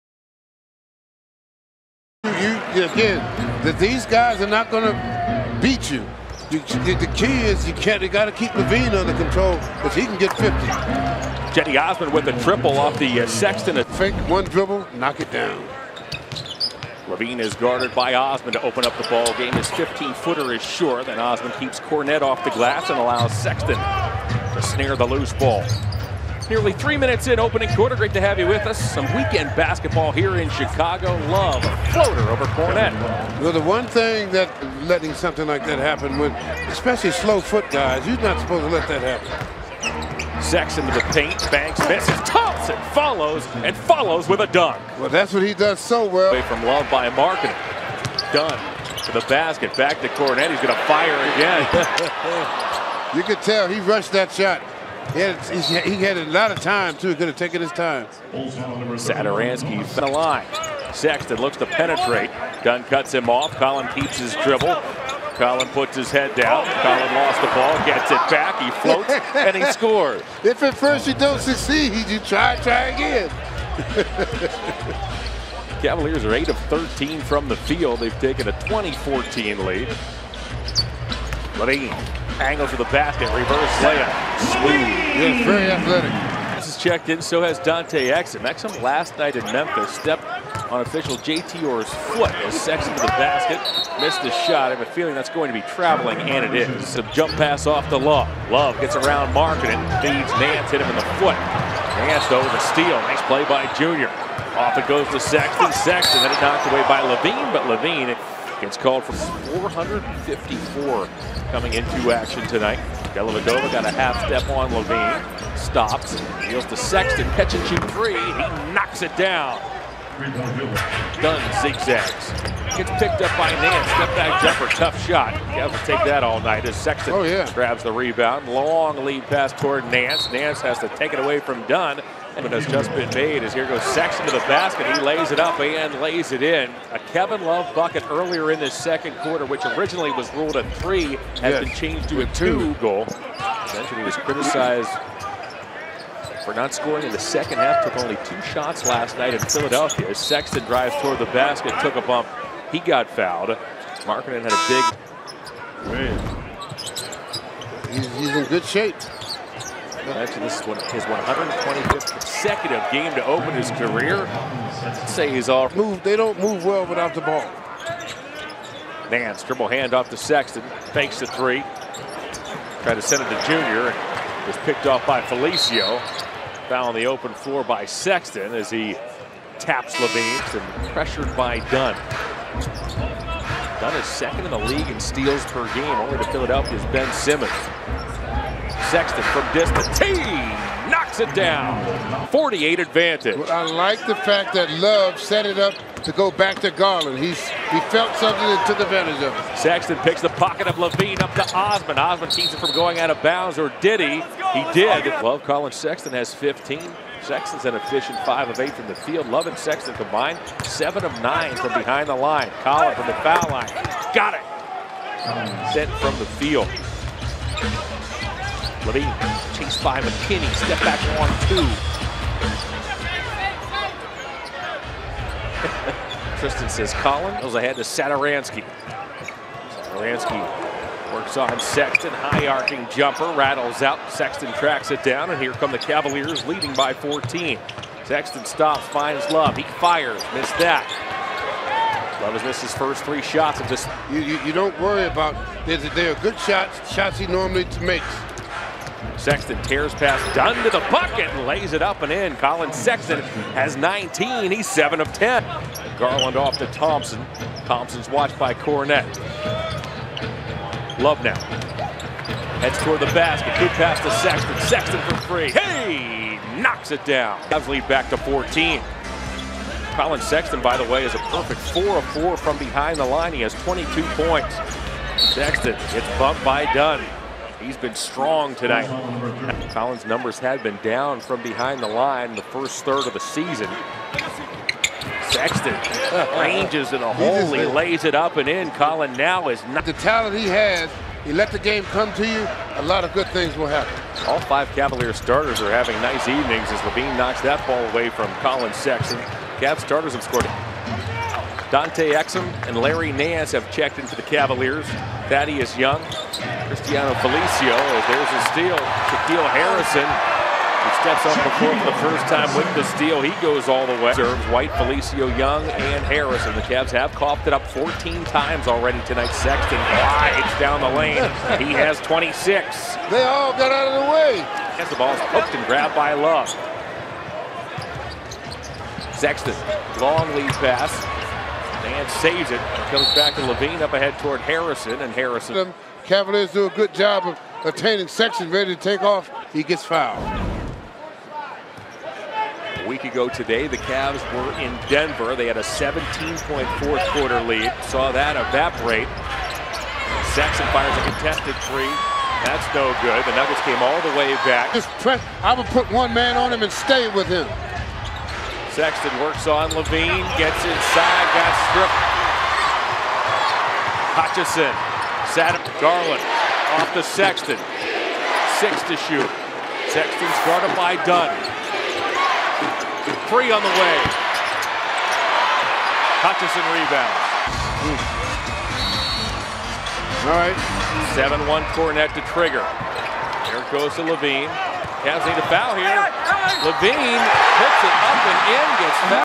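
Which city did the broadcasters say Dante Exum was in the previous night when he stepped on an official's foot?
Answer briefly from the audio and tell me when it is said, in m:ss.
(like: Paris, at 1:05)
Memphis, at 1:29.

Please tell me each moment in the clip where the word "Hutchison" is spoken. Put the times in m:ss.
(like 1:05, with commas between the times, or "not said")
6:04, 6:16.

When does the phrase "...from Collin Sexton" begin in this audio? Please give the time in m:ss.
4:58.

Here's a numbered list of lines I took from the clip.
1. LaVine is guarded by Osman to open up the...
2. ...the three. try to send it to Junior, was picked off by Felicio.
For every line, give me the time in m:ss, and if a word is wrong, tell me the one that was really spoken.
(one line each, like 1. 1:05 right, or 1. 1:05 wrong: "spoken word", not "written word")
1. 0:17 right
2. 2:51 right.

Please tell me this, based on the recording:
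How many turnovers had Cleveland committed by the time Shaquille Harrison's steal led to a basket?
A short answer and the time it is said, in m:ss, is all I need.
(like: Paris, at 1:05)
14, at 5:17.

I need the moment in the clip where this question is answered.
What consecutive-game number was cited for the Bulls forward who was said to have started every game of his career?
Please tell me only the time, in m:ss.
2:41.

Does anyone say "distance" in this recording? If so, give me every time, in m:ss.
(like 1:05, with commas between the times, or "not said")
3:09.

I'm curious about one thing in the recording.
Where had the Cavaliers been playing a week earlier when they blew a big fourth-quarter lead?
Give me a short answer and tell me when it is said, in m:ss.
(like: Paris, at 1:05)
Denver, at 5:44.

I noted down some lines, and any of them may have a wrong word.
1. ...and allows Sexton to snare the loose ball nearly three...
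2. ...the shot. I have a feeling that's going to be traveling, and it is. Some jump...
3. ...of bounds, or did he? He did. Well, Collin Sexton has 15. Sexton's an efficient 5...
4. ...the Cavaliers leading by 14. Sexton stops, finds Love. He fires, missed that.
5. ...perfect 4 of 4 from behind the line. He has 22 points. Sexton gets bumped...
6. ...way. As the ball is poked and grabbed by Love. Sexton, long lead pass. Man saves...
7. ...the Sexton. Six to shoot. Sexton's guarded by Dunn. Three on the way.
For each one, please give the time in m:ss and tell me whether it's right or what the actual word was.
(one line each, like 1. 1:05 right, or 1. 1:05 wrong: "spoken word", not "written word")
1. 0:22 right
2. 1:34 right
3. 3:23 right
4. 3:55 right
5. 4:31 right
6. 5:24 right
7. 6:06 right.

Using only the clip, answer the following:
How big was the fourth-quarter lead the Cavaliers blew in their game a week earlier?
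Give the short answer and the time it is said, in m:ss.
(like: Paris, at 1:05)
17 points, at 5:45.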